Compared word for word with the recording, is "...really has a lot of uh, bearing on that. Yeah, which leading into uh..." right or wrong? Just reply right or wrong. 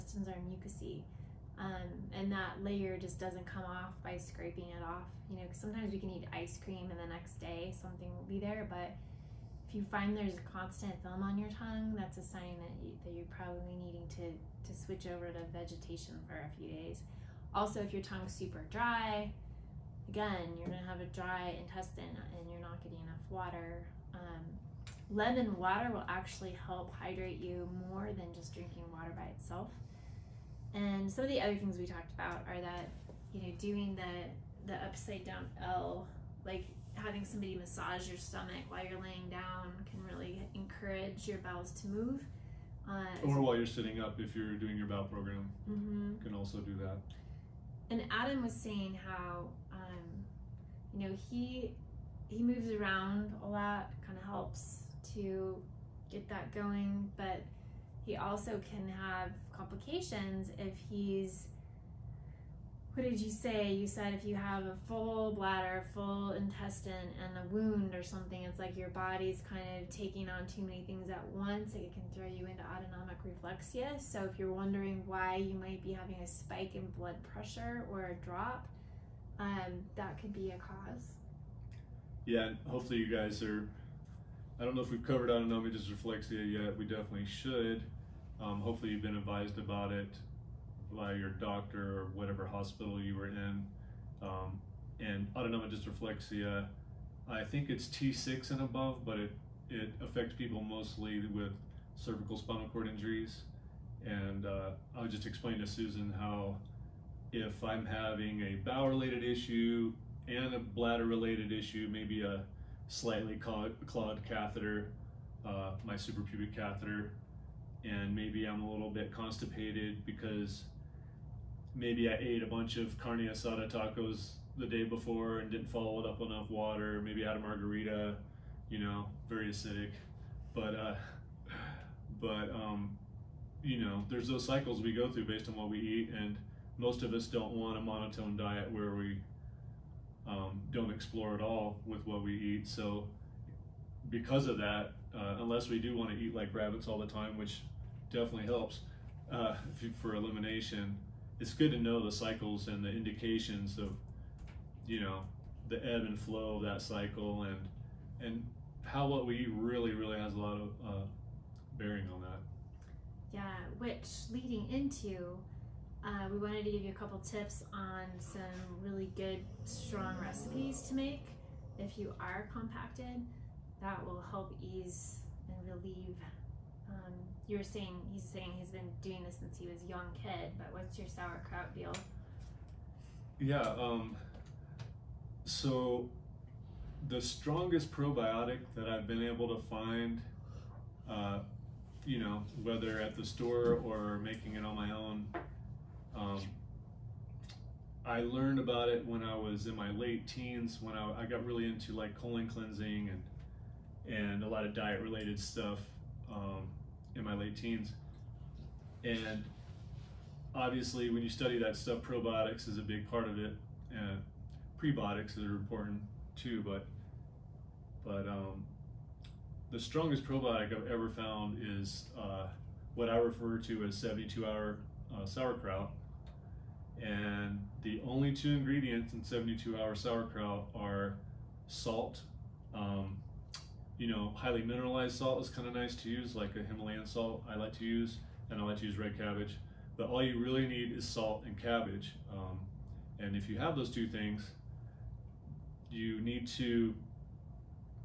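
right.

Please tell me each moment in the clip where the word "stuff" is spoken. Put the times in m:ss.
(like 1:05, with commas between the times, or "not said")
3:25, 3:31.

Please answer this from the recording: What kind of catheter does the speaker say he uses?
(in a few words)
Suprapubic catheter.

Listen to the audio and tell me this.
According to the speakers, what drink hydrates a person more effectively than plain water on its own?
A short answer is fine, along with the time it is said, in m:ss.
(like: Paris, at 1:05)
Lemon water, at 0:25.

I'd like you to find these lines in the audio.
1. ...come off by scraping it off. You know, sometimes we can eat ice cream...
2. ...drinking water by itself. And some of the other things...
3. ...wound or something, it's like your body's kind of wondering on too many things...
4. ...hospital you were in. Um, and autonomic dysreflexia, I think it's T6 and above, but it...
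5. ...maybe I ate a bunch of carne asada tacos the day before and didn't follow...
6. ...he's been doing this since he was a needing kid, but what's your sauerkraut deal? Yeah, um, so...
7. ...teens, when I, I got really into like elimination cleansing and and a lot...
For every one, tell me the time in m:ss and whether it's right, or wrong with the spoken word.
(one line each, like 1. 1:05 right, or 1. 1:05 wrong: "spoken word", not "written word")
1. 0:03 right
2. 0:28 right
3. 1:07 wrong: "taking", not "wondering"
4. 1:32 right
5. 2:01 right
6. 2:58 wrong: "young", not "needing"
7. 3:20 wrong: "colon", not "elimination".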